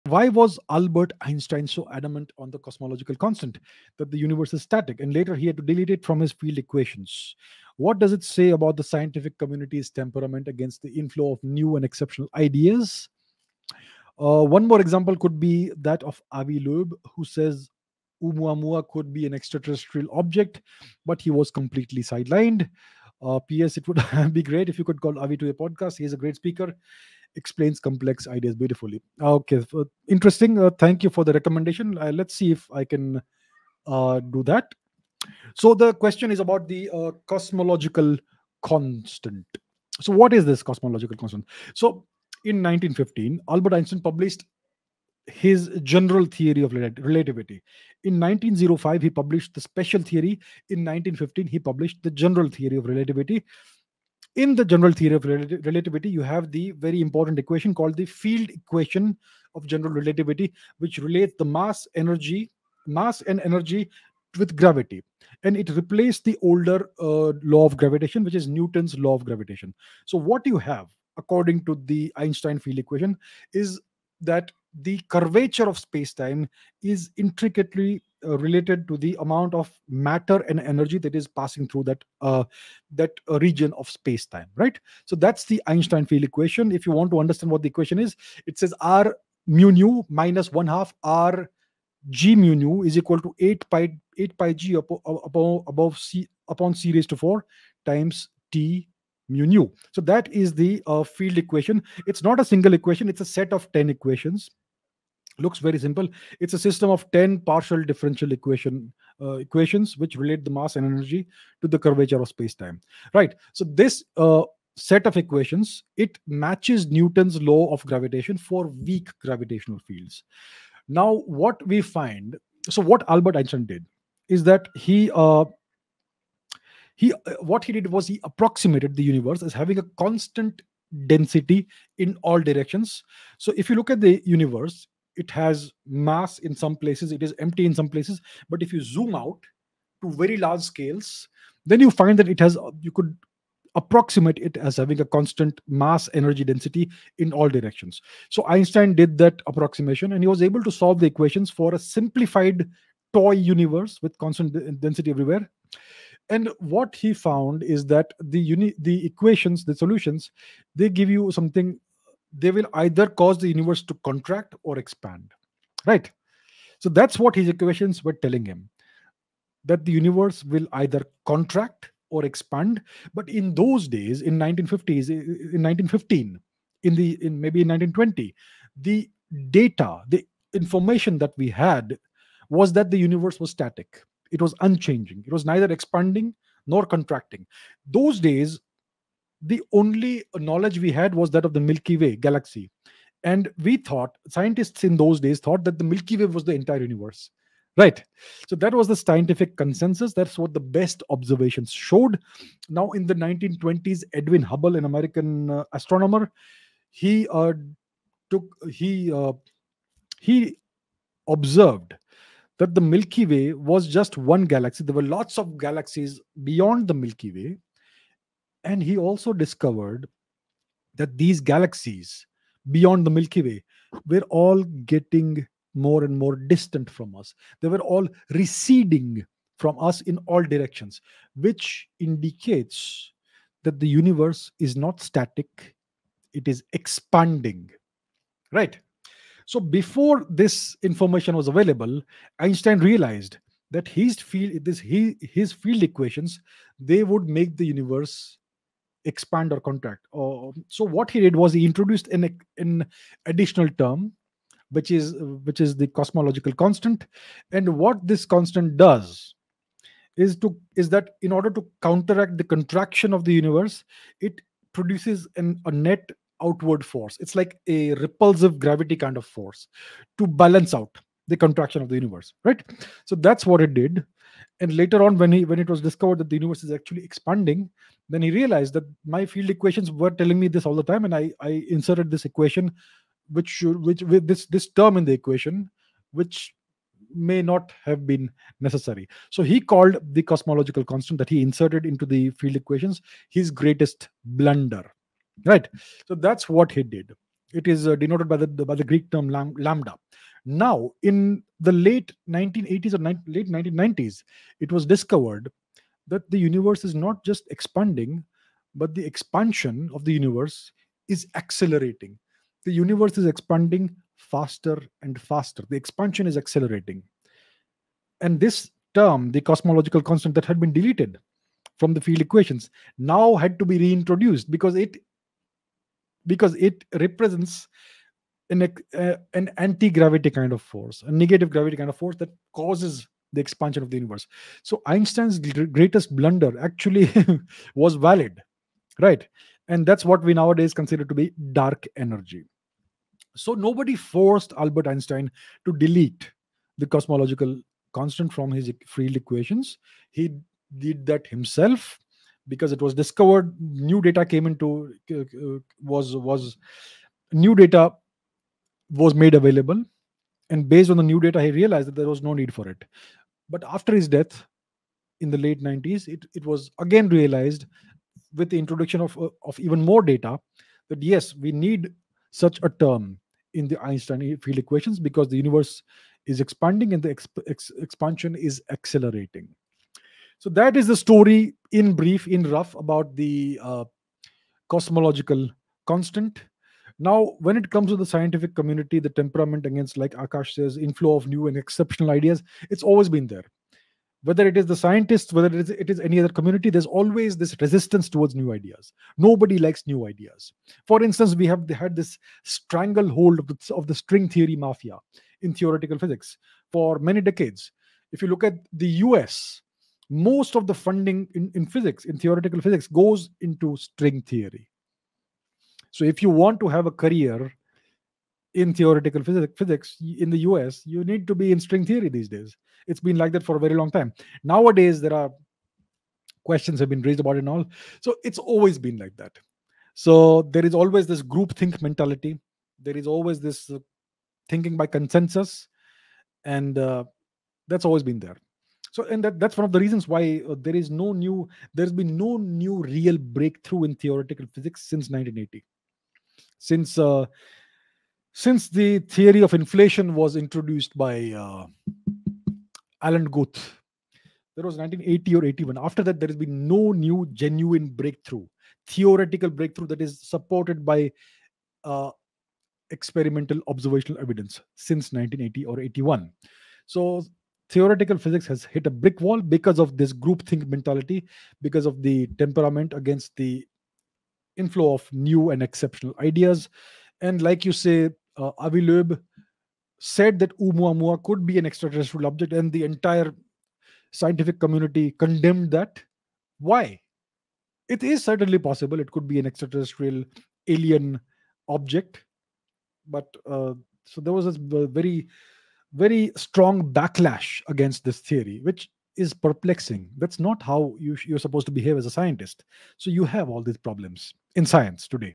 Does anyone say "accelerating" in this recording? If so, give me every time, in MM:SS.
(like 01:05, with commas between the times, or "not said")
05:11, 05:16, 06:18.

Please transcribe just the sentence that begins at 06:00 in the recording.
And based on the new data, he realized that there was no need for it.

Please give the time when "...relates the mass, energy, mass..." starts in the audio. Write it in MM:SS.
01:00.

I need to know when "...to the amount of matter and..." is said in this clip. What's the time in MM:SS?
01:18.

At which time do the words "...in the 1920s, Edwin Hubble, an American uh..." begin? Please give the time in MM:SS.
03:22.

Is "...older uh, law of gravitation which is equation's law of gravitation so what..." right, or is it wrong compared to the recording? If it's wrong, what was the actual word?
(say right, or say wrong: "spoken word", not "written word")
wrong: "newton", not "equation".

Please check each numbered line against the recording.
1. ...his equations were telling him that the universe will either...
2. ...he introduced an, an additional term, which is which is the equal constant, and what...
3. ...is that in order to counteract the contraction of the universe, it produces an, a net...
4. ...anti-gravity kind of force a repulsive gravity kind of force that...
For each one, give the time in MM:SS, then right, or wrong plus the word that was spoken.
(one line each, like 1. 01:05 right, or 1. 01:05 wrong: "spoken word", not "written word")
1. 02:47 right
2. 04:11 wrong: "cosmological", not "equal"
3. 04:20 right
4. 05:29 wrong: "negative", not "repulsive".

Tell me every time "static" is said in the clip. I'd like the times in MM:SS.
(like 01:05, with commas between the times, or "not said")
00:04, 03:03, 03:55.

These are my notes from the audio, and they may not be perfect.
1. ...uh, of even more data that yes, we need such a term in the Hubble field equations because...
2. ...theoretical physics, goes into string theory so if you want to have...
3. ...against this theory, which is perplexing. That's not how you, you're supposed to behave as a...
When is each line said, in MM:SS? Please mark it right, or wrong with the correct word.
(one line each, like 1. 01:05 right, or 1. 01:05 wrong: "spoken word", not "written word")
1. 06:09 wrong: "Einstein", not "Hubble"
2. 06:52 right
3. 08:17 right.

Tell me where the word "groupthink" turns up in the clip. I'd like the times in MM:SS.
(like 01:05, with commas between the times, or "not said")
07:11, 07:50.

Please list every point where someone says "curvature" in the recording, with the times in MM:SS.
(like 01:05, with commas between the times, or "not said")
01:15, 01:51.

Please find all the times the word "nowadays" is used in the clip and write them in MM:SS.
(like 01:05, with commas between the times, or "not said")
05:40, 07:04.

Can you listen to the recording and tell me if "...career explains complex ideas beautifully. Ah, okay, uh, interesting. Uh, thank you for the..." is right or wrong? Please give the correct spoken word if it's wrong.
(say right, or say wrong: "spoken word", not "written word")
wrong: "speaker", not "career".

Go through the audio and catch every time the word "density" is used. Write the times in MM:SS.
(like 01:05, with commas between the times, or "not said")
02:11, 02:26, 02:34.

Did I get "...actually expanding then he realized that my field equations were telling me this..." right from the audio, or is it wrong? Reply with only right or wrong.
right.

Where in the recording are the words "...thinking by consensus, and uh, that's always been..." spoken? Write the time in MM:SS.
07:14.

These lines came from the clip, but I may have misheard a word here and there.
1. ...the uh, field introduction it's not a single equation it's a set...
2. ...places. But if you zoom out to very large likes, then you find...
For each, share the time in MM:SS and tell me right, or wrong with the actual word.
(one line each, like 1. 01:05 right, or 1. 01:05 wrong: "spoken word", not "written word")
1. 01:40 wrong: "equation", not "introduction"
2. 02:17 wrong: "scales", not "likes".